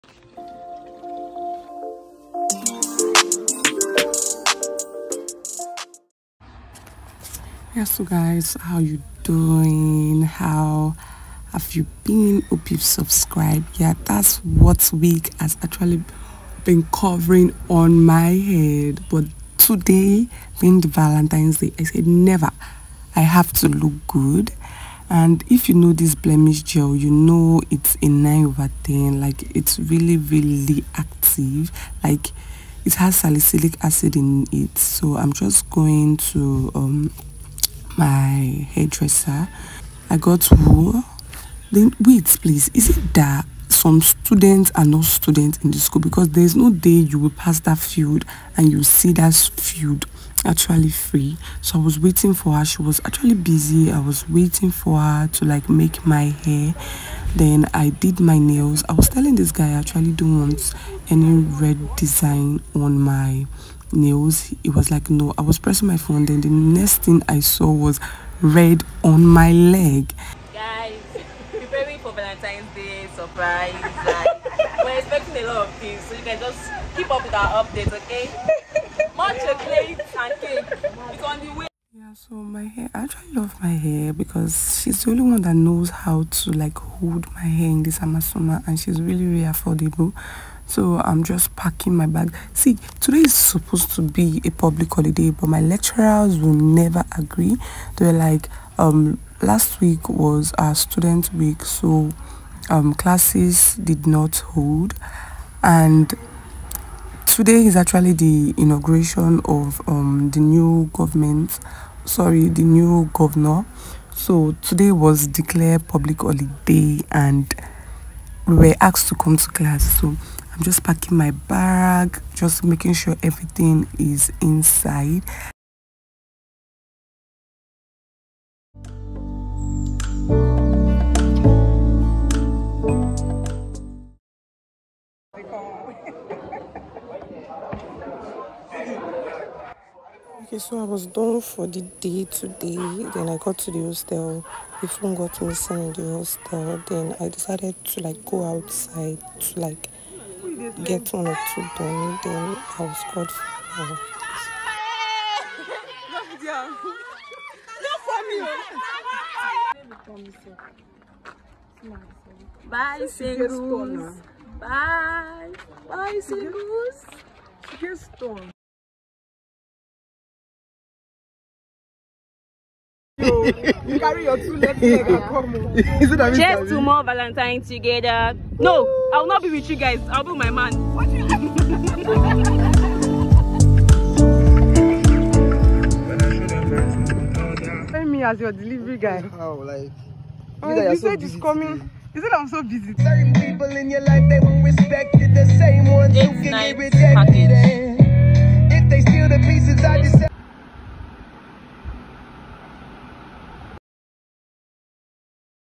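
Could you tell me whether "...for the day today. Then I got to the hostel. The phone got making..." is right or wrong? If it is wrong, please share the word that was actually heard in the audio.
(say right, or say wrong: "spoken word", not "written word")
wrong: "missing", not "making".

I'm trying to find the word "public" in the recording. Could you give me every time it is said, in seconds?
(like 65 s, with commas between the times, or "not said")
94 s, 115 s.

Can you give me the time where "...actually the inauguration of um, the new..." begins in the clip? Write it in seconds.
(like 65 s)
107 s.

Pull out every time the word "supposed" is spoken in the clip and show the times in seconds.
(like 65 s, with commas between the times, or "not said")
93 s.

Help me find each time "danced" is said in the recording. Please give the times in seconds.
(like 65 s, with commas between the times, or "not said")
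not said.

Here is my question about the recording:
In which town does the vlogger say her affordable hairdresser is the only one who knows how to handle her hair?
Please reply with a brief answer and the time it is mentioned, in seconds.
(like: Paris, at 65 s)
Amasoma, at 88 s.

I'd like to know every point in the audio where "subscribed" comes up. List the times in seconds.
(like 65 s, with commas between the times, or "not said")
12 s.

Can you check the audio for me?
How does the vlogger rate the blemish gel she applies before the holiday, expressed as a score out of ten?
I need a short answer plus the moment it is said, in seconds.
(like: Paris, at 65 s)
9/10, at 28 s.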